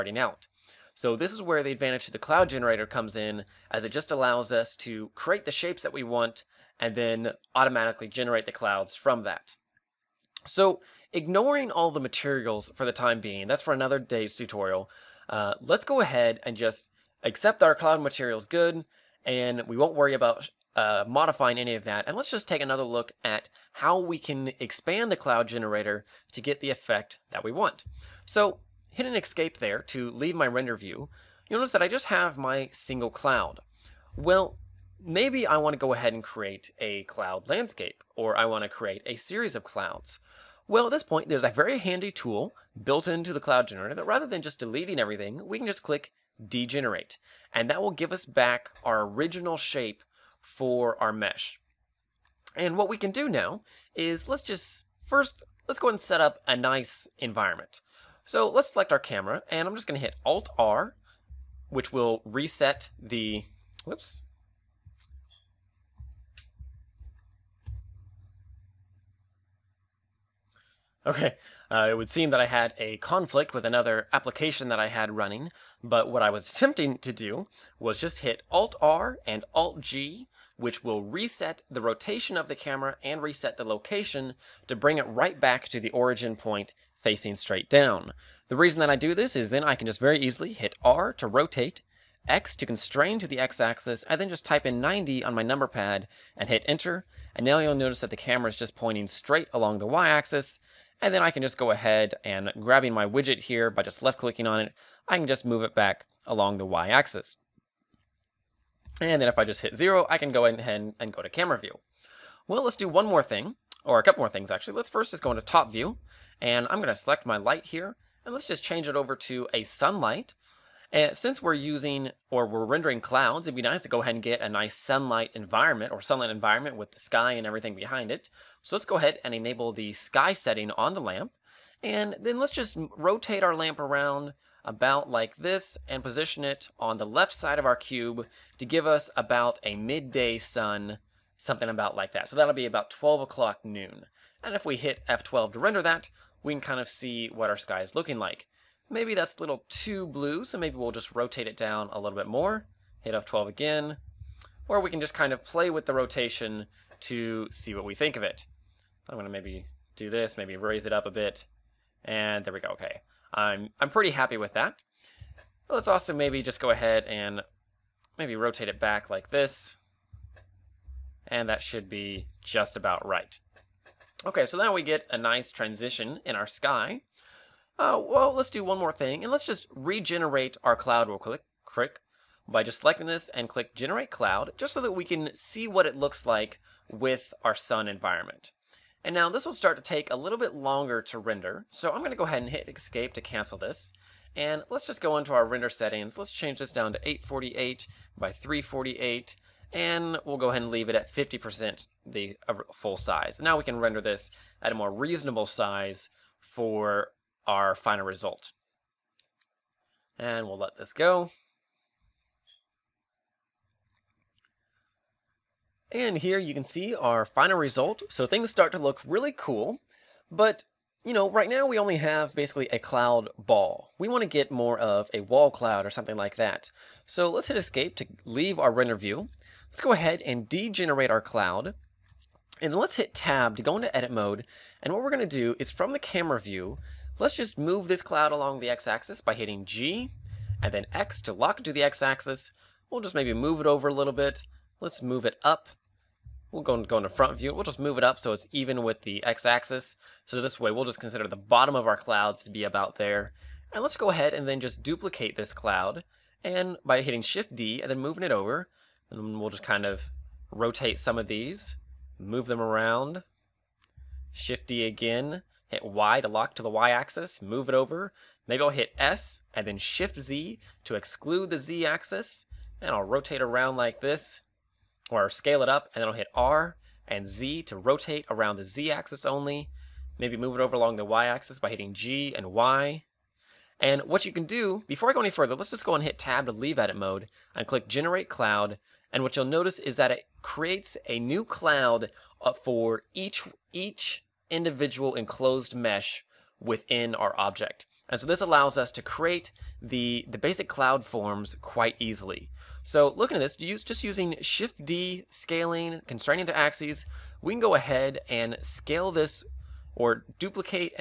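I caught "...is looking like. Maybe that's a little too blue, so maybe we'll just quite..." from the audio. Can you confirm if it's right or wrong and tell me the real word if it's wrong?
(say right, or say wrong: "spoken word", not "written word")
wrong: "rotate", not "quite".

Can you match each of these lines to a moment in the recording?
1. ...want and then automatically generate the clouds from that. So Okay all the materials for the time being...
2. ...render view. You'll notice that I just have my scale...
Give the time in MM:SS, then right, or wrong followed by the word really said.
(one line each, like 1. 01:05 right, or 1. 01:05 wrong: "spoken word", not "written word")
1. 00:06 wrong: "Ignoring", not "Okay"
2. 00:30 wrong: "single", not "scale".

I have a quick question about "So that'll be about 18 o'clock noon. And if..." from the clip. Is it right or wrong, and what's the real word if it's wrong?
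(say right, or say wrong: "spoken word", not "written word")
wrong: "12", not "18".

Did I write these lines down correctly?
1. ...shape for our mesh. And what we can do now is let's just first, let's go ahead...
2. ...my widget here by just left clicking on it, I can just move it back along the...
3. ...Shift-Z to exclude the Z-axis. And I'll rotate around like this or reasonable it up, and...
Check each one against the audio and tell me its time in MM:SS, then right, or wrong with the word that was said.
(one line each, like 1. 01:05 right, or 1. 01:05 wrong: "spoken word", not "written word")
1. 00:49 right
2. 01:42 right
3. 04:29 wrong: "scale", not "reasonable".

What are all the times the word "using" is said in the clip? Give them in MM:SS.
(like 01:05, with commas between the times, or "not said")
02:01, 05:04.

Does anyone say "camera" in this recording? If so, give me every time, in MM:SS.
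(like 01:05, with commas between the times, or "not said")
00:58, 01:22, 01:38, 01:51, 03:55.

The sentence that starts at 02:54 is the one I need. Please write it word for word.
Okay, so now we get a nice transition in our sky.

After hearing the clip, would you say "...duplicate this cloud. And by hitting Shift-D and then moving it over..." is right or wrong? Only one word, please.
right.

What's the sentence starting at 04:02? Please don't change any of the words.
We'll just maybe move it over a little bit.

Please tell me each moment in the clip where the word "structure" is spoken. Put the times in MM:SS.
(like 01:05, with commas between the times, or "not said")
not said.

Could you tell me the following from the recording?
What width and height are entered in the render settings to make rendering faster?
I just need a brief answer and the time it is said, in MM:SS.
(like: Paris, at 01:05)
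848 by 348, at 03:17.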